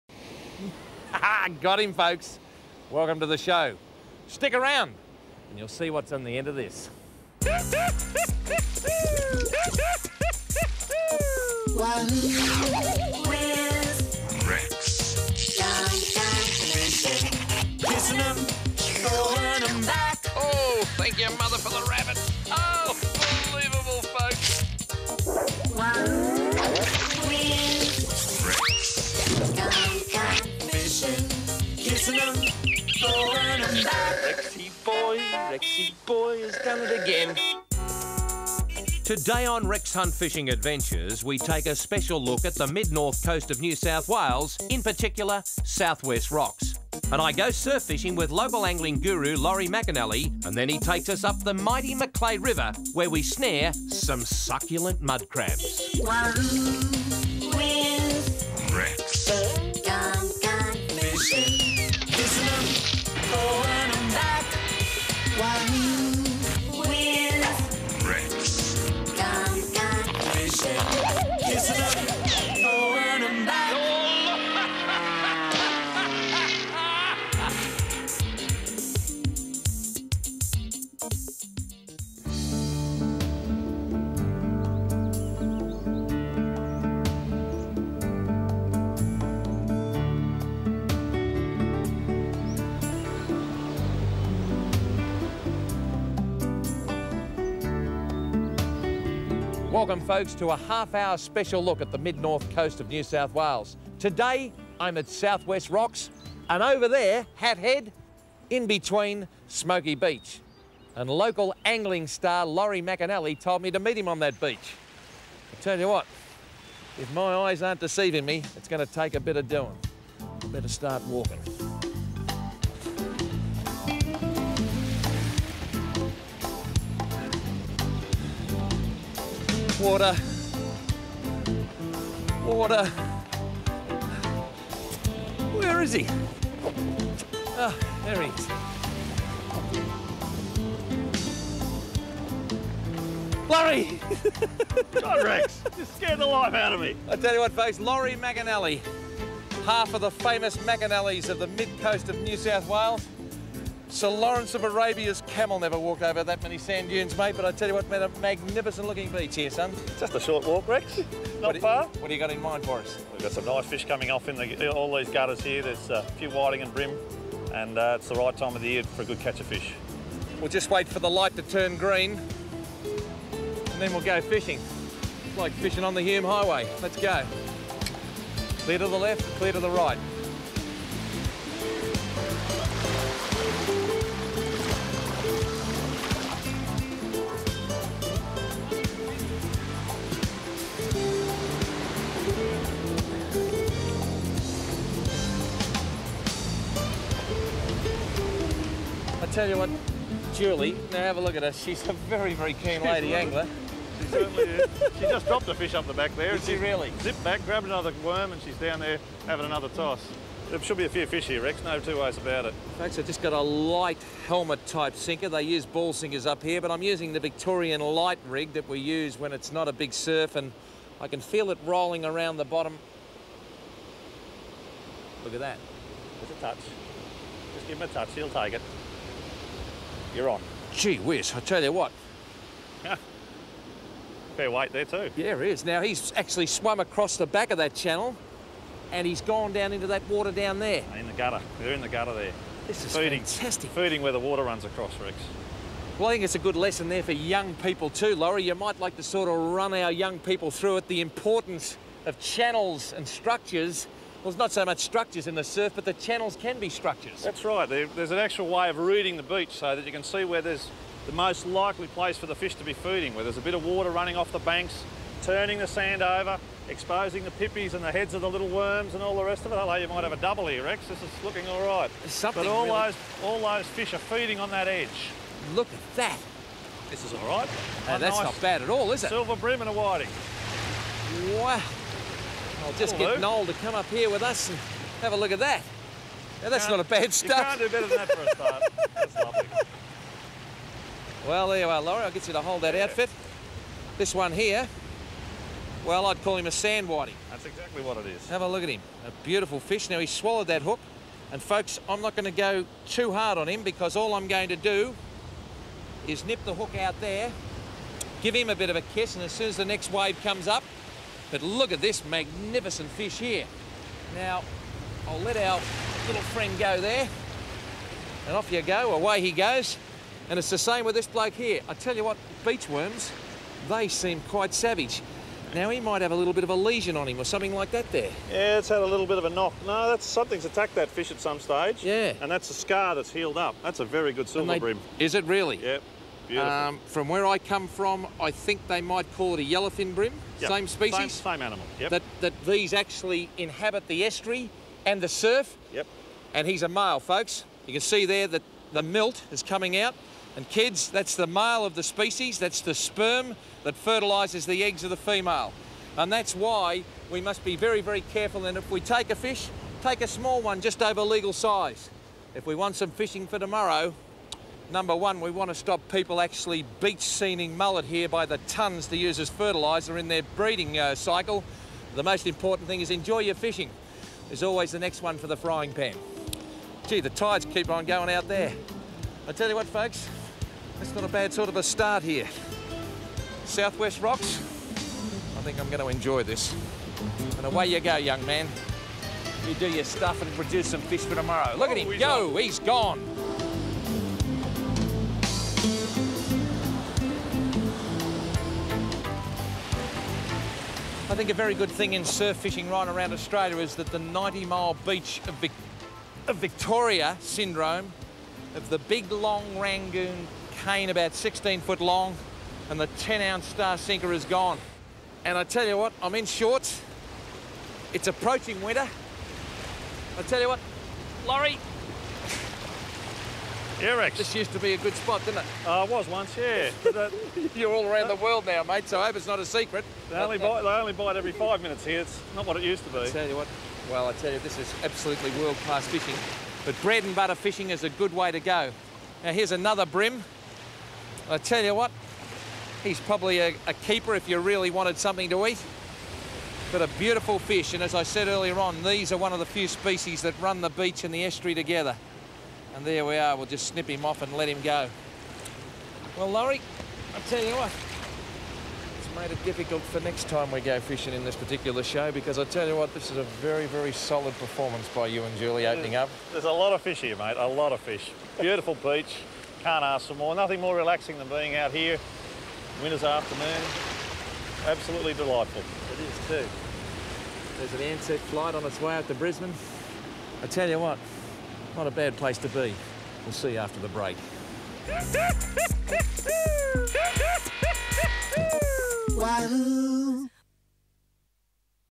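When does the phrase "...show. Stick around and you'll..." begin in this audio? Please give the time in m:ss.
0:03.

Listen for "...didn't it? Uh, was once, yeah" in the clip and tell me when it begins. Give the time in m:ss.
7:05.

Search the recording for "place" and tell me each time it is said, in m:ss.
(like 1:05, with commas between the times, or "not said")
4:21, 8:02.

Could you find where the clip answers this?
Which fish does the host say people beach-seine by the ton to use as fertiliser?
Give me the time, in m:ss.
6:07.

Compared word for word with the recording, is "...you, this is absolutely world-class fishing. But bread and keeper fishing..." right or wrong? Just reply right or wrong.
wrong.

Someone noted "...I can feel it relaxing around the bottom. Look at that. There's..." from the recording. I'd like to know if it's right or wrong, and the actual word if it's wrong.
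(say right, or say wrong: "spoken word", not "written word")
wrong: "rolling", not "relaxing".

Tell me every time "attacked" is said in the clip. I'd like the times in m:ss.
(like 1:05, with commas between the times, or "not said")
5:30.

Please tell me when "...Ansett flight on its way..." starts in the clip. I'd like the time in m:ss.
7:57.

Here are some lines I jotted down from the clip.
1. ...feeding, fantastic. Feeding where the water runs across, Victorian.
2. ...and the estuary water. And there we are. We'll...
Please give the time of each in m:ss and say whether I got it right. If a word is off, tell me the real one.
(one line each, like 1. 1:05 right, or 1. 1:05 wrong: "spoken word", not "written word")
1. 4:02 wrong: "Rex", not "Victorian"
2. 7:31 wrong: "together", not "water".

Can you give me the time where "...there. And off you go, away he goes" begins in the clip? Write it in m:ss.
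5:16.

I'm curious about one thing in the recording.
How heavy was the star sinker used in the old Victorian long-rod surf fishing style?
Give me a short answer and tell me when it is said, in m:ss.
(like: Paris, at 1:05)
10 ounces, at 6:52.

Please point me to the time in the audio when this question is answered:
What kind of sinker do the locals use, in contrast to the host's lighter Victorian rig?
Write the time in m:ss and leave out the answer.
3:35.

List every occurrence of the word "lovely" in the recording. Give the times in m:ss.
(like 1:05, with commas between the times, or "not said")
4:49.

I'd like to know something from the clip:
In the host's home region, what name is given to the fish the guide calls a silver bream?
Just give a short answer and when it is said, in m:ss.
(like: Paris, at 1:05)
yellowfin bream, at 5:39.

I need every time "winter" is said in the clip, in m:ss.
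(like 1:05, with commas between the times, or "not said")
6:58, 7:52.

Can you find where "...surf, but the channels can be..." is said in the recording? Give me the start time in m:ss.
4:15.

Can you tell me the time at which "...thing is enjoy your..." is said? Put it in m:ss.
6:12.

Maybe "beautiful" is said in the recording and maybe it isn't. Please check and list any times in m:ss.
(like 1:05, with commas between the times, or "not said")
4:59, 7:26, 7:48.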